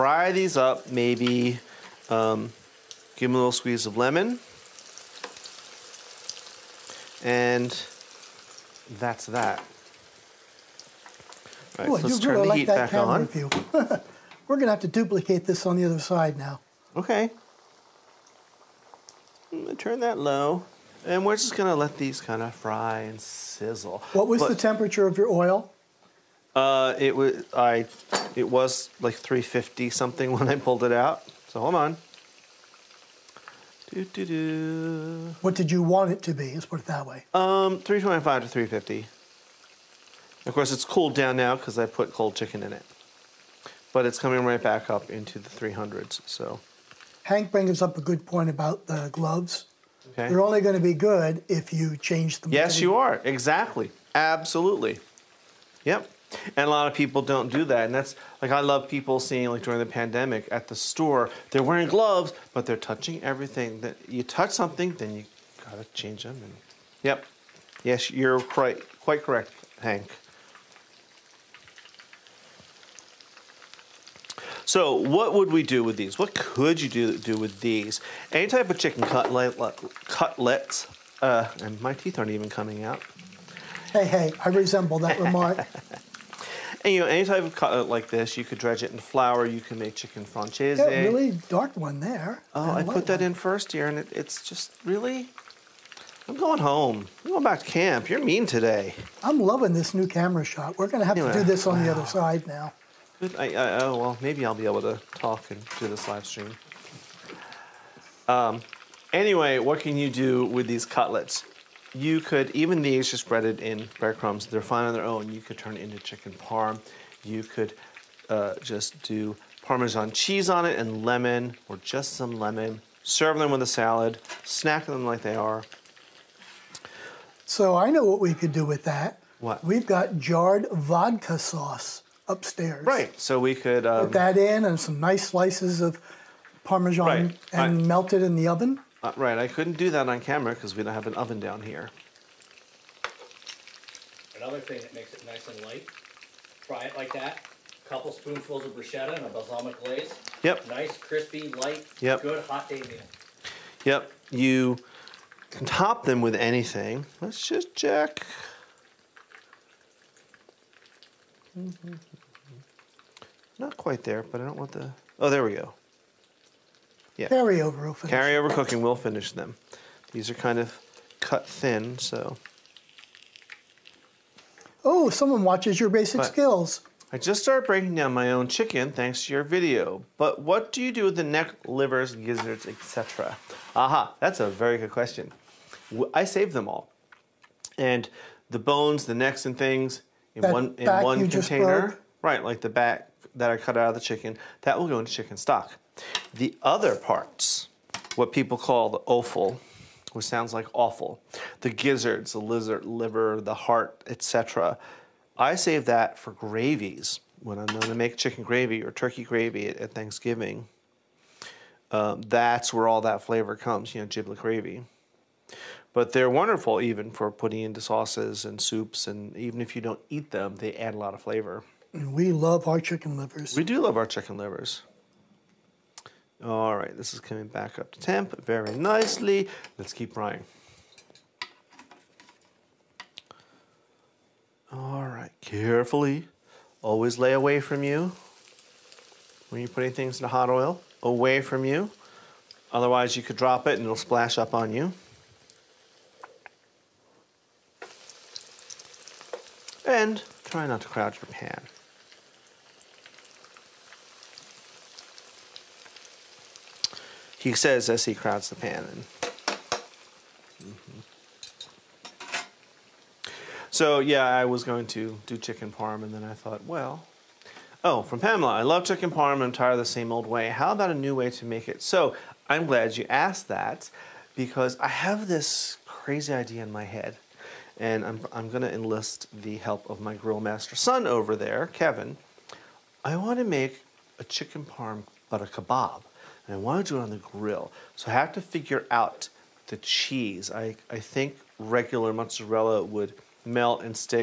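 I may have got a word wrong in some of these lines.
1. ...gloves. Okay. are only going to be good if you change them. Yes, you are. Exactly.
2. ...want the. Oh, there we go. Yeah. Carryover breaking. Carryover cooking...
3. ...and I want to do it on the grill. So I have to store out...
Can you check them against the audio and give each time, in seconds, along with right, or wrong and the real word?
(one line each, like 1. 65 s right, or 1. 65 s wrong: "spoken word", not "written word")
1. 49 s right
2. 164 s wrong: "cooking", not "breaking"
3. 286 s wrong: "figure", not "store".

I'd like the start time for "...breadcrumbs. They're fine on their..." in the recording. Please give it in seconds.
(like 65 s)
113 s.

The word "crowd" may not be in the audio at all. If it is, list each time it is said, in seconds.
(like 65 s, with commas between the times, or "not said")
250 s, 258 s.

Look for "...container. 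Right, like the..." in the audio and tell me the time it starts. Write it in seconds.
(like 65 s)
191 s.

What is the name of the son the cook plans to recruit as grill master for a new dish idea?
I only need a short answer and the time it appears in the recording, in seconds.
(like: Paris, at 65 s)
Kevin, at 281 s.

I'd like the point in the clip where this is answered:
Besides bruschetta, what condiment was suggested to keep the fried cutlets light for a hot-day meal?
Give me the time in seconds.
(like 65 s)
149 s.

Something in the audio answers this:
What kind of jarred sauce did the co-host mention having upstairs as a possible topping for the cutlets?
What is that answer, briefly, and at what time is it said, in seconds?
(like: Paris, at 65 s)
Vodka sauce, at 130 s.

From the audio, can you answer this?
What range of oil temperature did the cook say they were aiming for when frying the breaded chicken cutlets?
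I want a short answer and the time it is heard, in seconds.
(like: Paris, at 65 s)
325 to 350, at 37 s.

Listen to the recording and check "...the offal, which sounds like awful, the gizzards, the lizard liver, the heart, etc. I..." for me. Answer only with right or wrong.
right.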